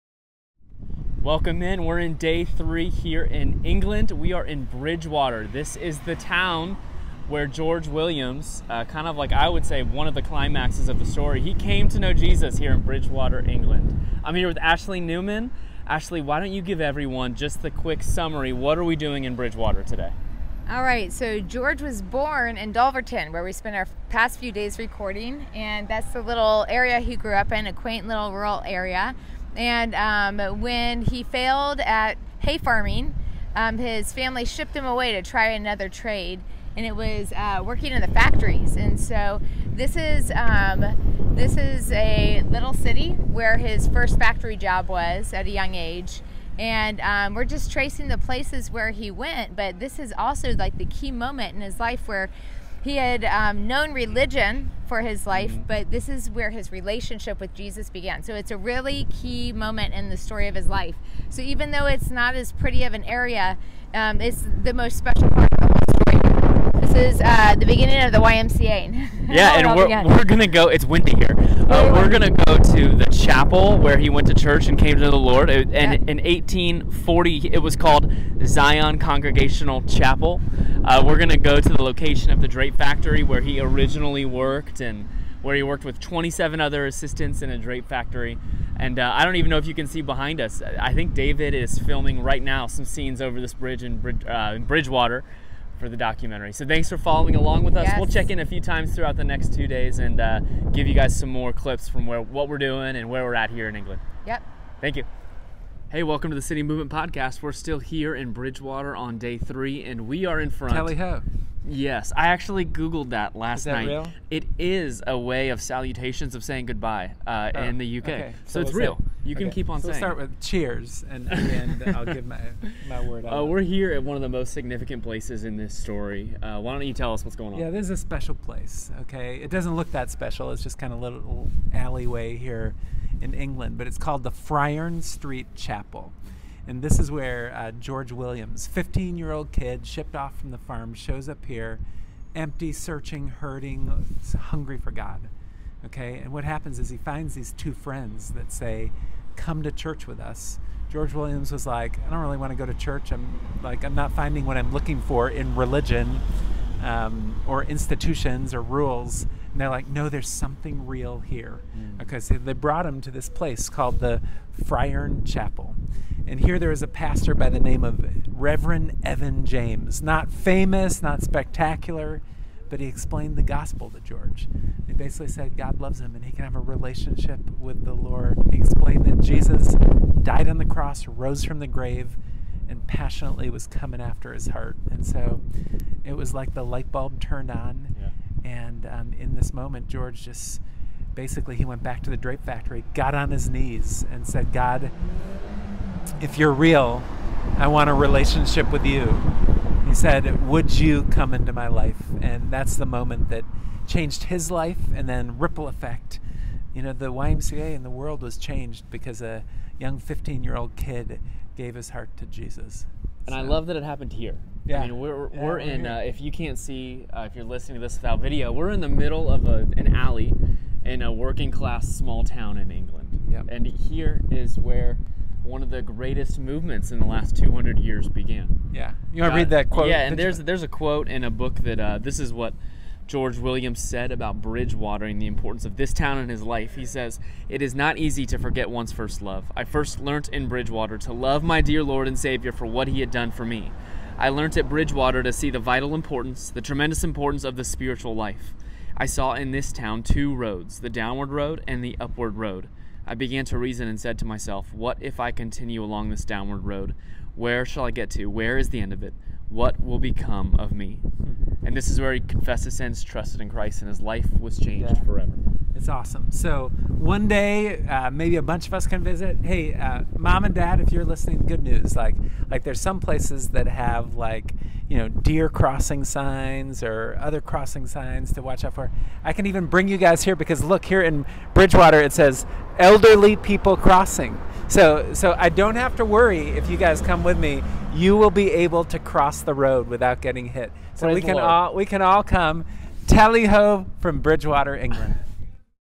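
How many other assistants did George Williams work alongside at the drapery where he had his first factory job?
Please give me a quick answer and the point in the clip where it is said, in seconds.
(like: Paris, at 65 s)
27, at 85 s.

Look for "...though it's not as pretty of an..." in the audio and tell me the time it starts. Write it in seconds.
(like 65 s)
61 s.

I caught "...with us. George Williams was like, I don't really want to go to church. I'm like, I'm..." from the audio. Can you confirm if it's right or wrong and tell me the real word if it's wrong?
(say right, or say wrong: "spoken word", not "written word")
right.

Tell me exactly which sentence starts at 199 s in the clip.
He said, Would you come into my life?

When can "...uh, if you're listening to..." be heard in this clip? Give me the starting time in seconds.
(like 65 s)
217 s.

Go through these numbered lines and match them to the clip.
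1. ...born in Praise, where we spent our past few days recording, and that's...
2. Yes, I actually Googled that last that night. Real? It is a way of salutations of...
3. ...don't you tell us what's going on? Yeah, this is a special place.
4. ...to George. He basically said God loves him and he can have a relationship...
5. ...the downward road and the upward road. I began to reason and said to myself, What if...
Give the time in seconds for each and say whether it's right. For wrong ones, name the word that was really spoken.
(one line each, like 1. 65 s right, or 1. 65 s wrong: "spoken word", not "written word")
1. 22 s wrong: "Dulverton", not "Praise"
2. 111 s right
3. 126 s right
4. 173 s right
5. 250 s right.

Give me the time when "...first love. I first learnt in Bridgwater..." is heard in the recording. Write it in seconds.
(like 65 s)
238 s.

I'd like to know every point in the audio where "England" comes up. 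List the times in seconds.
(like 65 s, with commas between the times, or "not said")
3 s, 13 s, 103 s, 133 s, 222 s, 294 s.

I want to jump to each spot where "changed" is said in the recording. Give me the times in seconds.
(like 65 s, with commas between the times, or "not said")
203 s, 208 s, 264 s.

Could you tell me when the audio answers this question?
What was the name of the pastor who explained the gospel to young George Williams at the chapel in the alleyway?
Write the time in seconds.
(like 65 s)
168 s.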